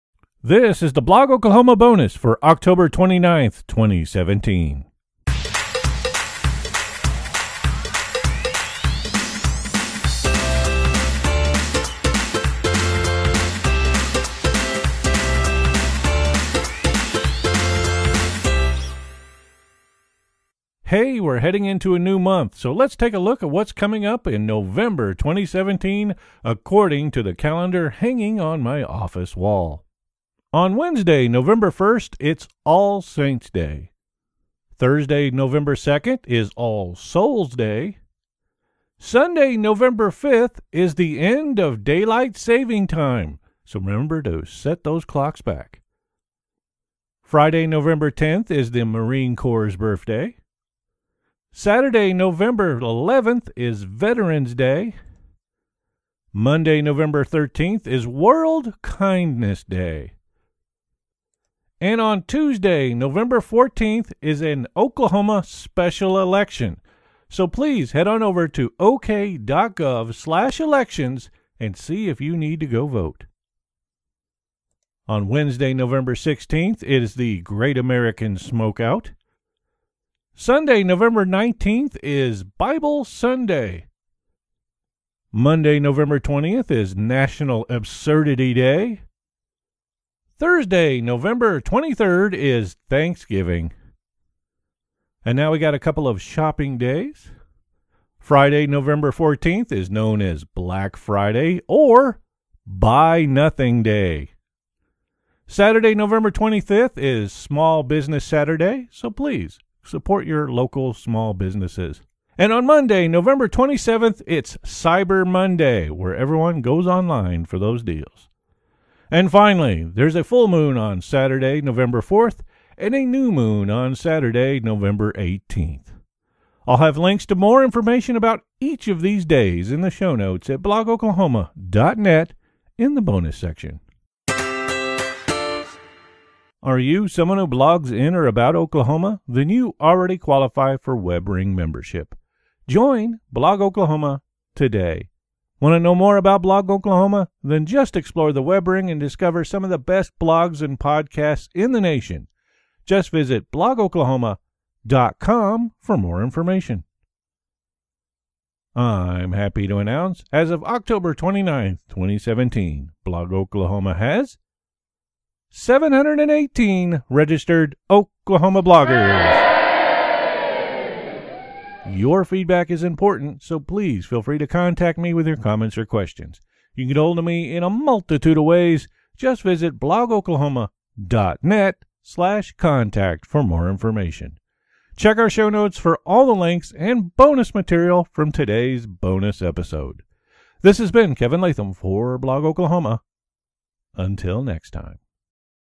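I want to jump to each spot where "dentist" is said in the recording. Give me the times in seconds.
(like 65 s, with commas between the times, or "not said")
not said.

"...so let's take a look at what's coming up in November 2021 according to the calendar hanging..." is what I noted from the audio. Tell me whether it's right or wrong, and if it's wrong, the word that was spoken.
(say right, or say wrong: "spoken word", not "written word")
wrong: "2017", not "2021".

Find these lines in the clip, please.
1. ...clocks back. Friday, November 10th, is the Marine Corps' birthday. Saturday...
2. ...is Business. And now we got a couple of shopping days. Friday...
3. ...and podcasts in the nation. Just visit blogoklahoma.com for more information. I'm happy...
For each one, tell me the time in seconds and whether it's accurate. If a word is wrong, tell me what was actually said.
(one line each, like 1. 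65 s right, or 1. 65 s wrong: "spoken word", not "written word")
1. 45 s right
2. 92 s wrong: "Thanksgiving", not "Business"
3. 150 s right.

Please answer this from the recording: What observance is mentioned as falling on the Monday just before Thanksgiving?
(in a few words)
National Absurdity Day.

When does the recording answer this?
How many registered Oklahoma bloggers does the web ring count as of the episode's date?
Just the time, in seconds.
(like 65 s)
165 s.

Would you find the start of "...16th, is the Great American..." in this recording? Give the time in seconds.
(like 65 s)
76 s.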